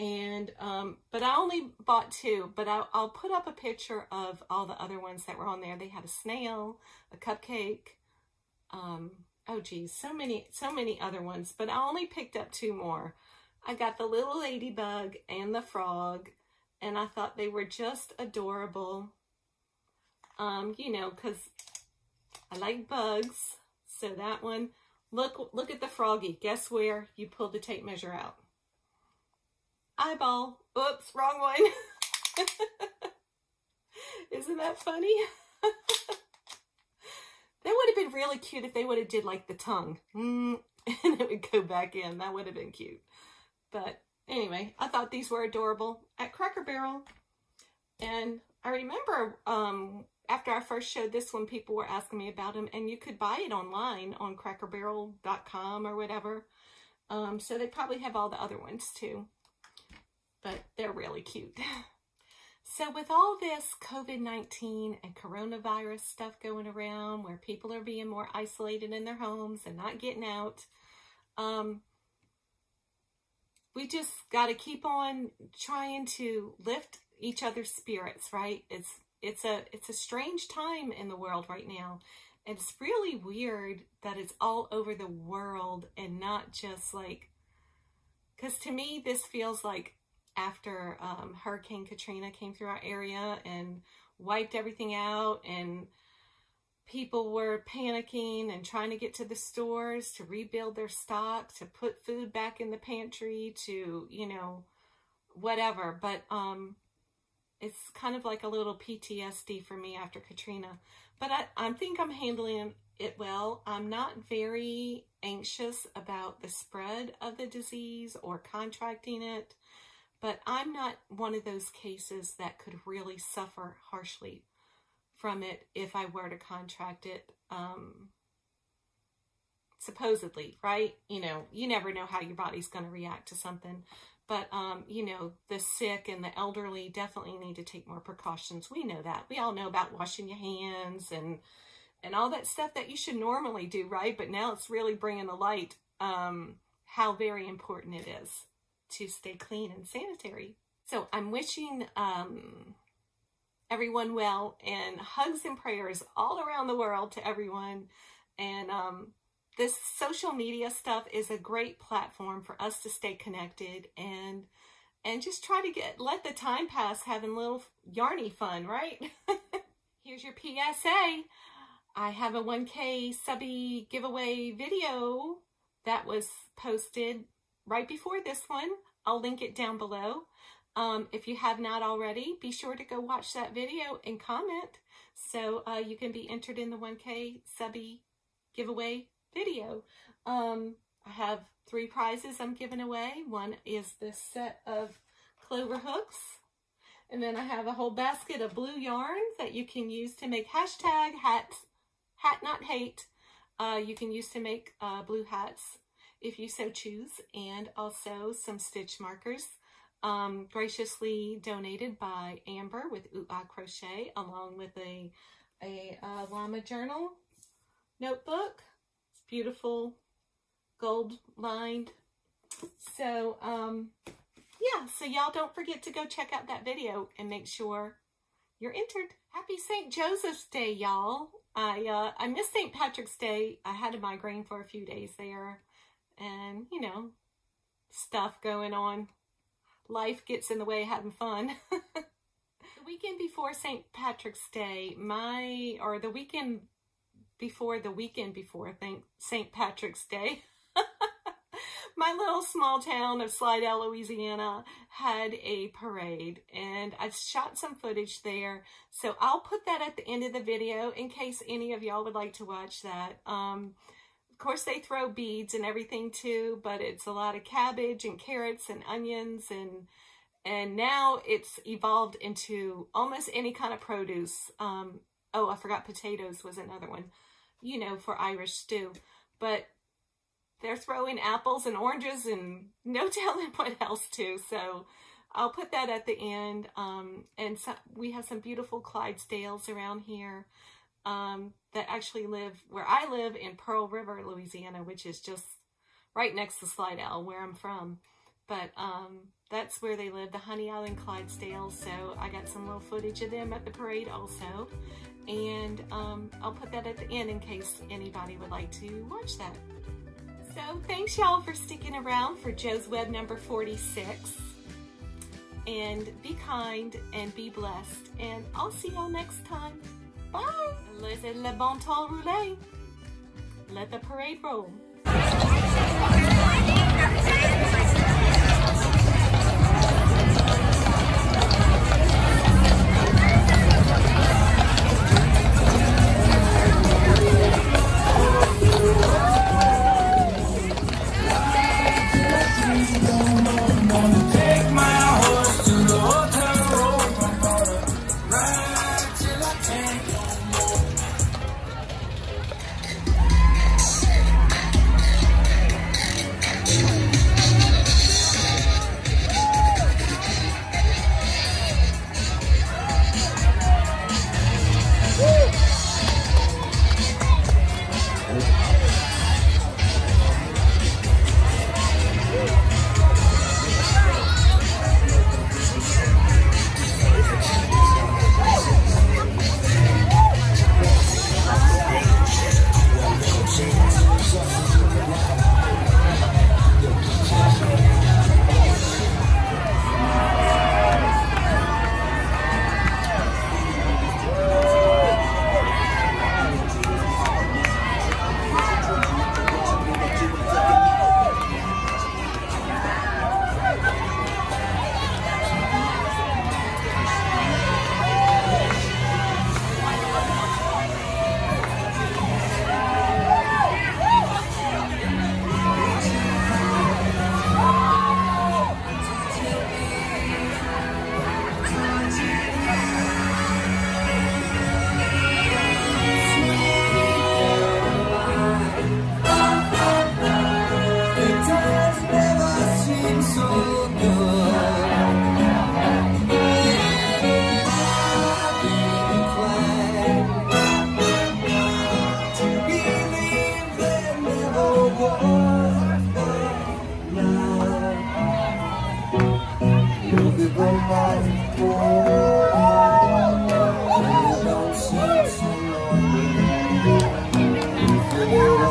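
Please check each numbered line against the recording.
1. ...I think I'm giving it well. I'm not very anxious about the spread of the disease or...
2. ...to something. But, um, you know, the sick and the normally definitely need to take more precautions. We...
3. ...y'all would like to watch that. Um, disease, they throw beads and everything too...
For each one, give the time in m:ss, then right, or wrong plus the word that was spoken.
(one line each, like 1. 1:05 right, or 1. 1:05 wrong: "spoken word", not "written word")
1. 1:51 wrong: "handling", not "giving"
2. 2:13 wrong: "elderly", not "normally"
3. 4:21 wrong: "course", not "disease".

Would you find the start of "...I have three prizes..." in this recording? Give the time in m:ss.
3:11.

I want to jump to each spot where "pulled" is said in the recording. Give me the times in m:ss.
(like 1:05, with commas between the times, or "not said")
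0:27.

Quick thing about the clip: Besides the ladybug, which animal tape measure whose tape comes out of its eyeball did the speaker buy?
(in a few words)
Frog.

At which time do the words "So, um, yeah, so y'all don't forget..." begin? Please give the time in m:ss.
3:42.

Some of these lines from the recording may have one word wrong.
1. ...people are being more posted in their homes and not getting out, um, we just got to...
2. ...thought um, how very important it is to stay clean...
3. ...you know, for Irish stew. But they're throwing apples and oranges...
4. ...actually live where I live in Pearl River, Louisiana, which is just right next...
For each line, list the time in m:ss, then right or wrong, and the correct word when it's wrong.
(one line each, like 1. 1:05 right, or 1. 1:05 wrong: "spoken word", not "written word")
1. 1:07 wrong: "isolated", not "posted"
2. 2:25 wrong: "light", not "thought"
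3. 4:37 right
4. 4:51 right.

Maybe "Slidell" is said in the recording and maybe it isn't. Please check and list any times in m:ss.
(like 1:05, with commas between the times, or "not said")
4:13, 4:56.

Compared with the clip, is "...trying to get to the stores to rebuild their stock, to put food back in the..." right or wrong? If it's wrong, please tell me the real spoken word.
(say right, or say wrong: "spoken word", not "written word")
right.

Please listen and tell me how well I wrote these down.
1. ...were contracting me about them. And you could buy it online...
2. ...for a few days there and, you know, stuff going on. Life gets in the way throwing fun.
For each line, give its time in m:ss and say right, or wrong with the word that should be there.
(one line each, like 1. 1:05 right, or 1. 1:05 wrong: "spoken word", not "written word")
1. 0:51 wrong: "asking", not "contracting"
2. 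3:54 wrong: "having", not "throwing".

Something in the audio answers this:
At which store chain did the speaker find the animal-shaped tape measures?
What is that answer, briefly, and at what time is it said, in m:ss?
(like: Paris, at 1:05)
Cracker Barrel, at 0:46.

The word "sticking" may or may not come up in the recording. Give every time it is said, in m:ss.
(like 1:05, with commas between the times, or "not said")
5:11.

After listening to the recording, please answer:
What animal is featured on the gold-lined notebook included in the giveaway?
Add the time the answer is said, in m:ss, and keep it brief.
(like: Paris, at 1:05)
Llama, at 3:36.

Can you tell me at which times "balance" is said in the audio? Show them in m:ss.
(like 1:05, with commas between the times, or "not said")
not said.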